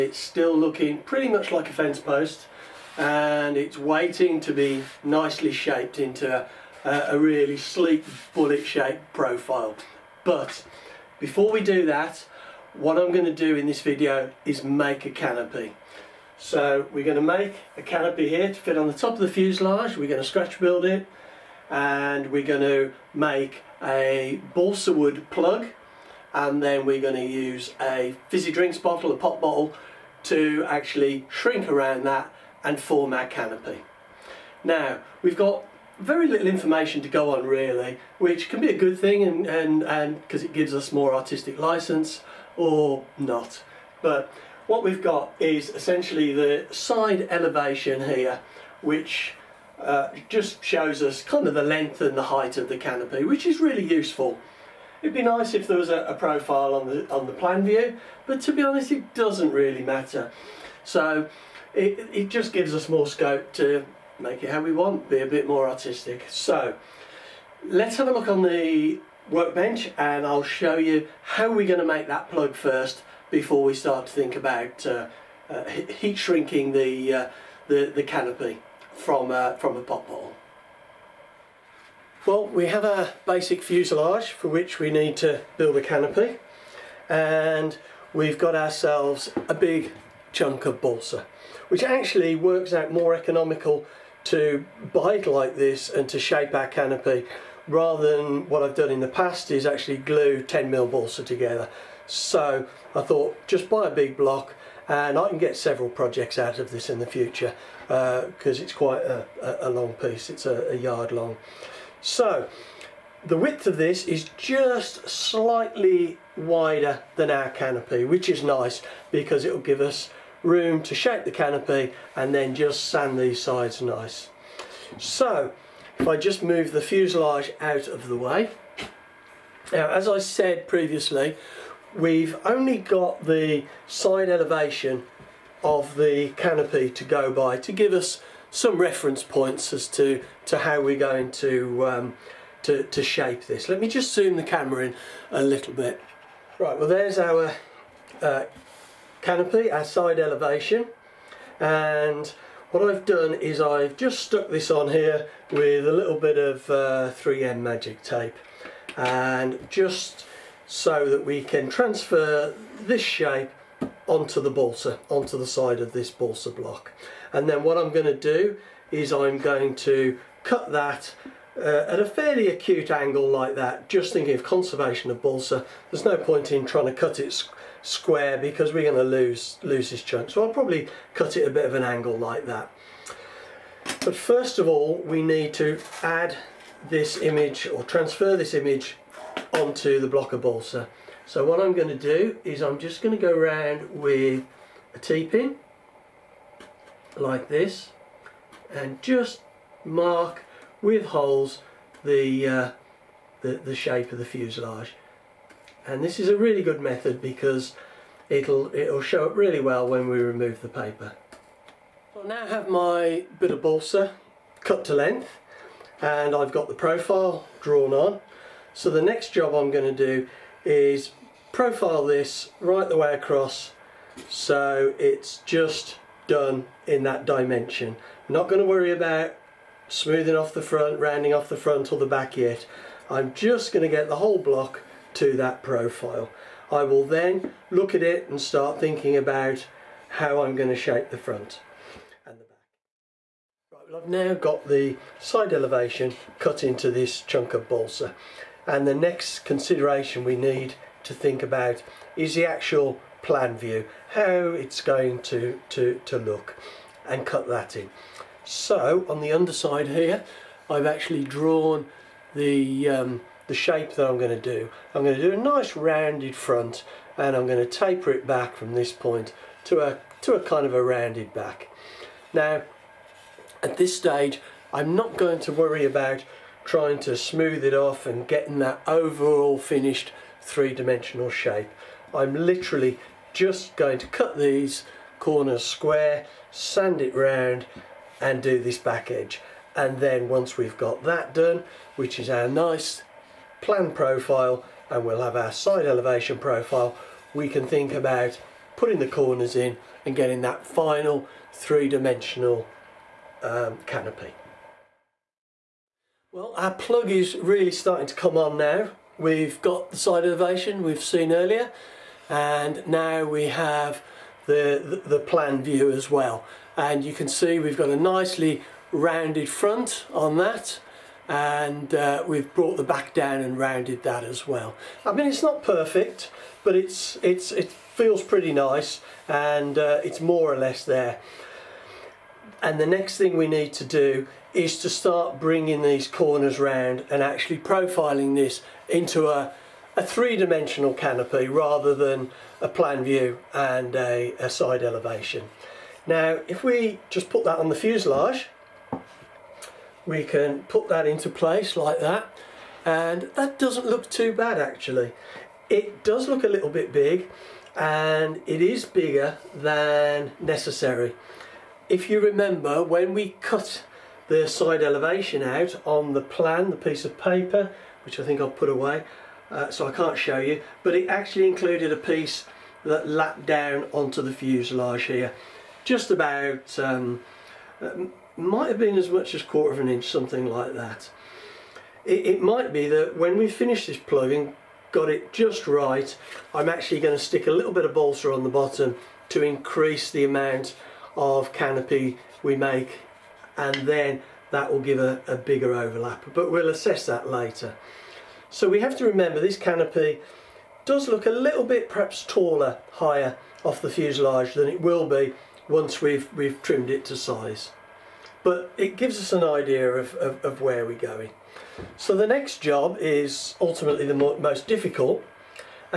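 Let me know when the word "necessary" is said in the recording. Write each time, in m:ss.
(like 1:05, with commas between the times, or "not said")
6:00.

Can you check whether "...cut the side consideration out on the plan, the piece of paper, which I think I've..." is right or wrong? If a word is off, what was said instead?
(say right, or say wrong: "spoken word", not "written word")
wrong: "elevation", not "consideration".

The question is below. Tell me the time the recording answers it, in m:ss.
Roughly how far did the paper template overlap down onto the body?
6:19.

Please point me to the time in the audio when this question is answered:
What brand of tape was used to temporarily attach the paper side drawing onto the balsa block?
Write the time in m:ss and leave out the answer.
2:37.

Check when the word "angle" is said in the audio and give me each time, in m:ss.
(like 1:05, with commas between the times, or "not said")
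2:52, 3:01.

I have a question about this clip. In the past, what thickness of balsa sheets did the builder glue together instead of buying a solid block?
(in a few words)
10mm.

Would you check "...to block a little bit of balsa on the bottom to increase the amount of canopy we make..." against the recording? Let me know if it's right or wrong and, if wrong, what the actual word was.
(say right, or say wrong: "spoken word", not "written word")
wrong: "stick", not "block".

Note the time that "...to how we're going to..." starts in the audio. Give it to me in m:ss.
2:20.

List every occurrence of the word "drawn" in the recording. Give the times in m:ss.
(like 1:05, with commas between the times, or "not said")
3:37, 4:21.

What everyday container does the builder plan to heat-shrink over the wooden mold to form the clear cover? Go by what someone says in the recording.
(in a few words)
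fizzy drinks bottle.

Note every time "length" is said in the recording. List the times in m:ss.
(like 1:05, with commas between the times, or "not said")
0:51, 3:34.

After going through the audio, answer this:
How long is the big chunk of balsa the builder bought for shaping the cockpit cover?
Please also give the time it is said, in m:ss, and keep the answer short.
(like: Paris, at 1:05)
a yard, at 1:50.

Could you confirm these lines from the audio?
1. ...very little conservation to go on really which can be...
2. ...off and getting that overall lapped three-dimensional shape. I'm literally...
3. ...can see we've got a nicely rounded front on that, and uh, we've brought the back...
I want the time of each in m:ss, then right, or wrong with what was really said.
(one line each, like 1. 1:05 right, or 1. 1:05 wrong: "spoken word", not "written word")
1. 0:35 wrong: "information", not "conservation"
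2. 4:37 wrong: "finished", not "lapped"
3. 5:17 right.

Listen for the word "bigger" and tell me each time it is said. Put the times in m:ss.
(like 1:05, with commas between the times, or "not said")
5:58, 6:35.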